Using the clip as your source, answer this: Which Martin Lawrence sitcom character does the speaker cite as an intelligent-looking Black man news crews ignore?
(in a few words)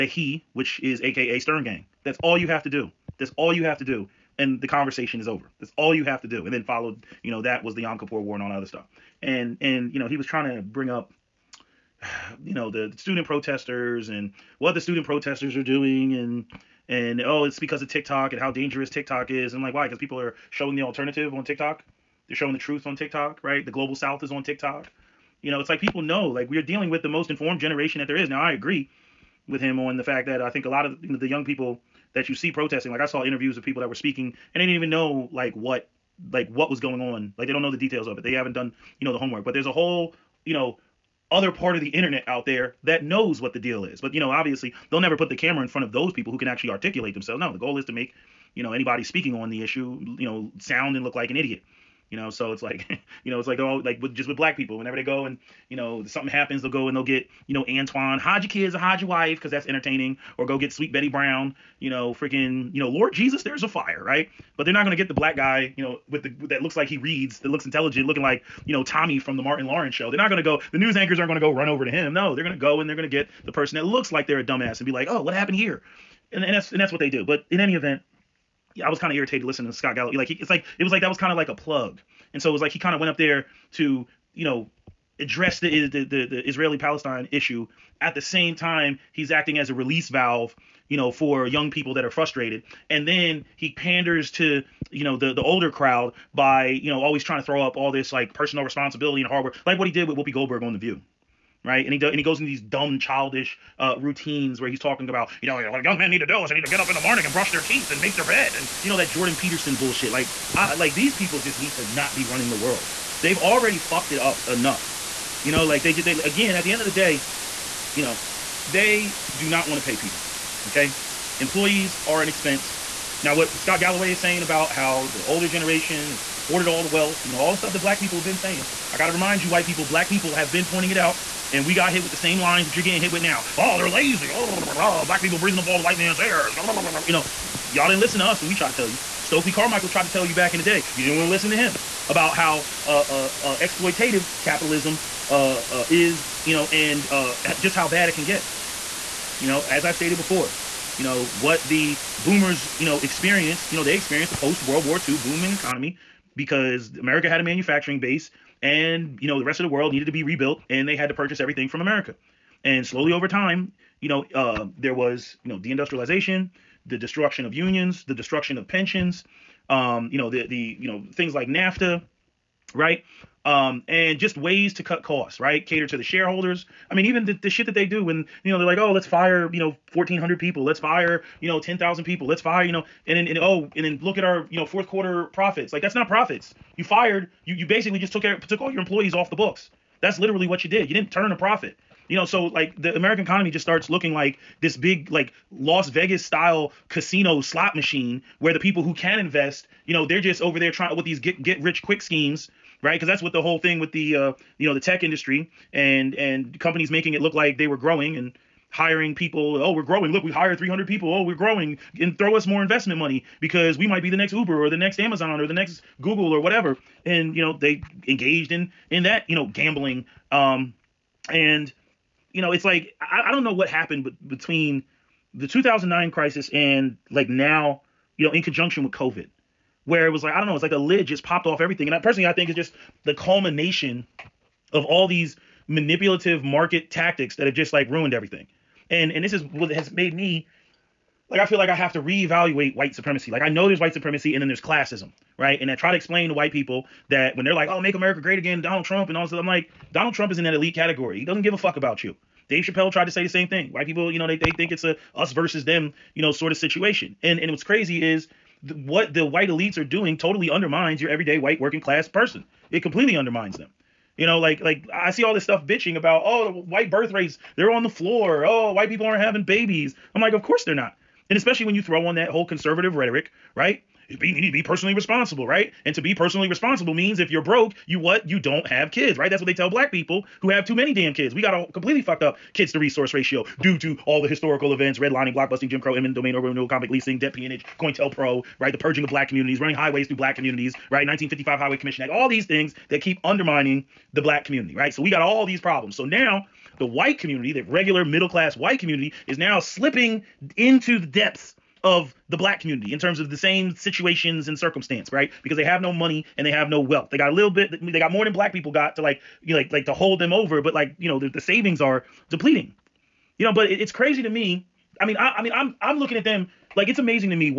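Tommy.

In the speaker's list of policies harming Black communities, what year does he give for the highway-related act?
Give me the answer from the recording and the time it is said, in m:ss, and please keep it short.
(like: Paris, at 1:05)
1955, at 4:51.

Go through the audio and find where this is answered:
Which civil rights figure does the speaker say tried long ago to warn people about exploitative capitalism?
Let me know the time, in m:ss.
2:19.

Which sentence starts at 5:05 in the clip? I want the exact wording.
Because they have no money and they have no wealth.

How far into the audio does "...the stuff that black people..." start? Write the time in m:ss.
2:07.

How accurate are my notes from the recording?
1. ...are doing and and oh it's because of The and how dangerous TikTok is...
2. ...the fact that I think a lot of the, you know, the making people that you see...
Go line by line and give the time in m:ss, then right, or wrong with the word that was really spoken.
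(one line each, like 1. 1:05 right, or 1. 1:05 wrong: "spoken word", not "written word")
1. 0:15 wrong: "TikTok", not "The"
2. 0:29 wrong: "young", not "making".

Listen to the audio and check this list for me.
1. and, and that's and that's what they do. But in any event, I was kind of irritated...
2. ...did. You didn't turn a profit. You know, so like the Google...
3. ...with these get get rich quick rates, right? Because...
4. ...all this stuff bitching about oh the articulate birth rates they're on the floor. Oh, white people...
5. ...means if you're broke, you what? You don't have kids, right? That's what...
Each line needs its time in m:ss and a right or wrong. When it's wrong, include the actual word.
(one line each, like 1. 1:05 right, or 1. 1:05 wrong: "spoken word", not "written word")
1. 1:16 right
2. 3:10 wrong: "American", not "Google"
3. 3:20 wrong: "schemes", not "rates"
4. 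4:25 wrong: "white", not "articulate"
5. 4:36 right.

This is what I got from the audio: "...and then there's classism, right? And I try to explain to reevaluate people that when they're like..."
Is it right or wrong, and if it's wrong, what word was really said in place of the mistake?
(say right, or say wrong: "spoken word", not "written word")
wrong: "white", not "reevaluate".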